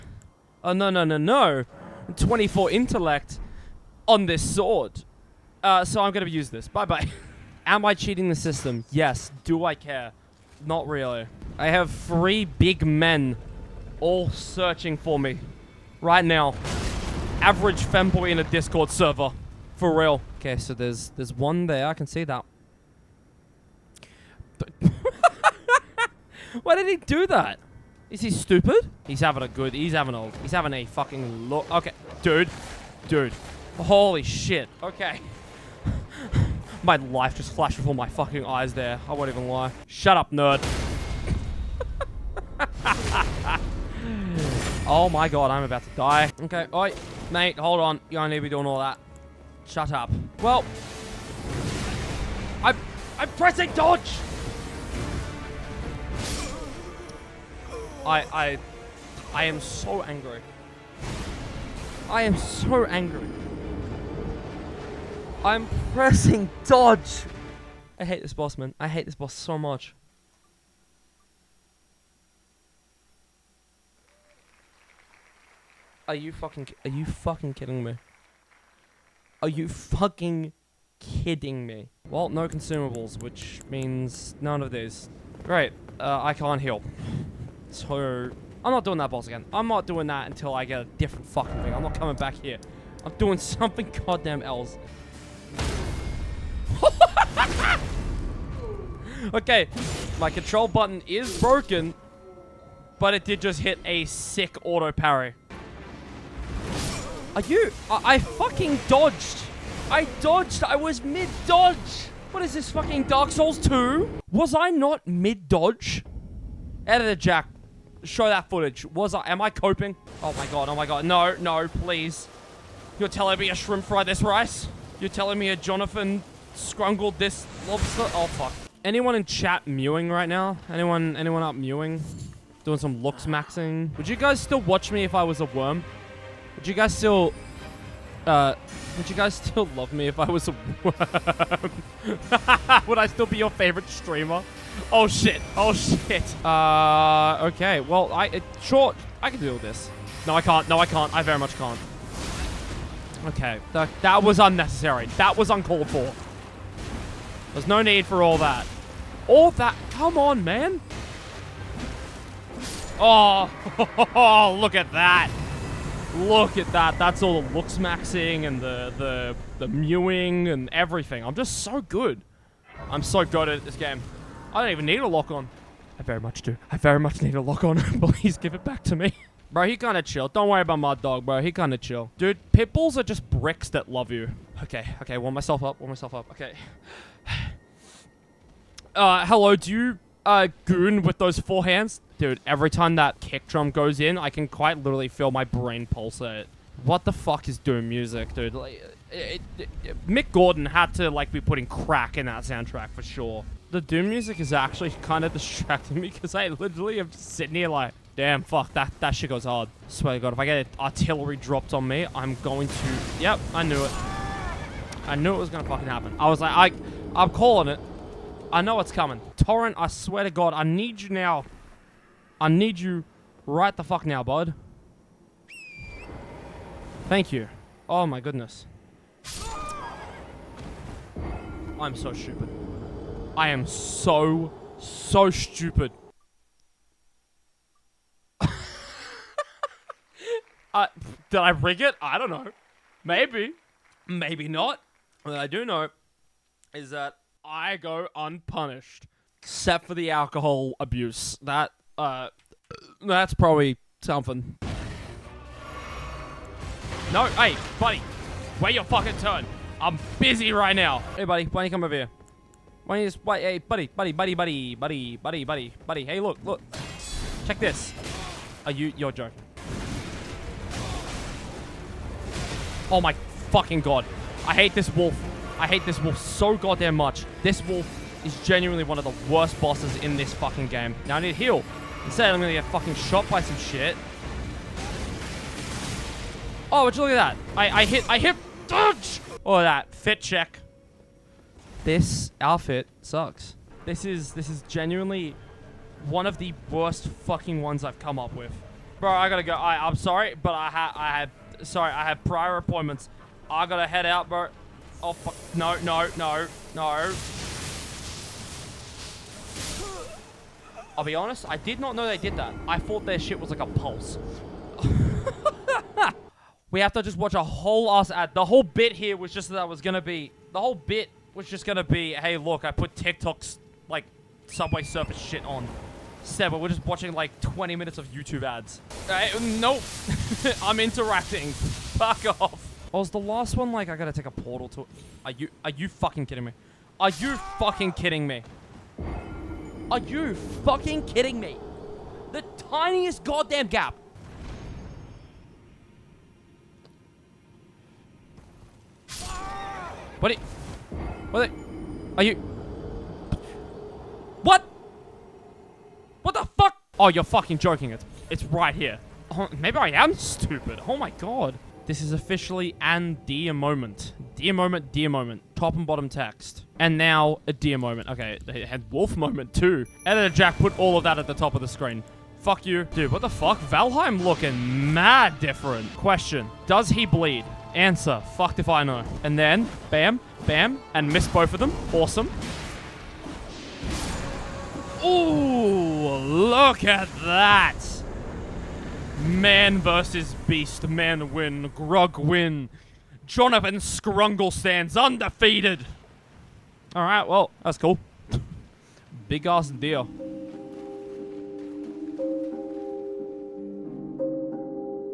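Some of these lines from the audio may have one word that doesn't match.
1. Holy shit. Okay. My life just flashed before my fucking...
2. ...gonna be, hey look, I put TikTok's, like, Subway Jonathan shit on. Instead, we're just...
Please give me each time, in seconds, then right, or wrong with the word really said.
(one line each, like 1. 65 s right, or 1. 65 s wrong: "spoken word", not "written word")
1. 33 s right
2. 321 s wrong: "Surfers", not "Jonathan".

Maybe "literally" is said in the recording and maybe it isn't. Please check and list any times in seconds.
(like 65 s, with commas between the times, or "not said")
194 s, 206 s.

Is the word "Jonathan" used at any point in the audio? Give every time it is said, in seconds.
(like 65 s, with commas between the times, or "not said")
125 s, 393 s.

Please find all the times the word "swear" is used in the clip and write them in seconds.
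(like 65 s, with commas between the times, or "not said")
209 s, 219 s.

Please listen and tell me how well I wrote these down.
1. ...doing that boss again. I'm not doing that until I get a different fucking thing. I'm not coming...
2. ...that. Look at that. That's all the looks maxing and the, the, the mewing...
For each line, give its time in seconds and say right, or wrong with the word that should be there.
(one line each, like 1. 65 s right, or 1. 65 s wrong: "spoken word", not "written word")
1. 88 s right
2. 164 s right.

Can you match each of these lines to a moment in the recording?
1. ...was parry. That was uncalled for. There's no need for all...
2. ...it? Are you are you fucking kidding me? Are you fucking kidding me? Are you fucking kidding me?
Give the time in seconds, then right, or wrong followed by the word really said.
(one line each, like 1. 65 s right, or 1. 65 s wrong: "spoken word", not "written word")
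1. 154 s wrong: "unnecessary", not "parry"
2. 334 s right.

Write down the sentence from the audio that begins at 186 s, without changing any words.
Okay uh, hello, do you uh, goon with those four hands?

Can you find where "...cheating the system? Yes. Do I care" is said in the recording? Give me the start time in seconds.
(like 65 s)
7 s.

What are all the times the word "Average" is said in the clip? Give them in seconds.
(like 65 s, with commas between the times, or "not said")
17 s.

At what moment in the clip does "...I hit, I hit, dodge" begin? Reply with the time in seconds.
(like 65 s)
287 s.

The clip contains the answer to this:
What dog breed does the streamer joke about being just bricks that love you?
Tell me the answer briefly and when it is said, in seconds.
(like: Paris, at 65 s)
Pit bulls, at 182 s.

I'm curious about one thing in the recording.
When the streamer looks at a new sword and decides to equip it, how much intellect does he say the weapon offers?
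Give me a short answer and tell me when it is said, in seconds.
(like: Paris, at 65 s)
24, at 2 s.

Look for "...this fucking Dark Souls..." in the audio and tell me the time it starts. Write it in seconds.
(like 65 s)
112 s.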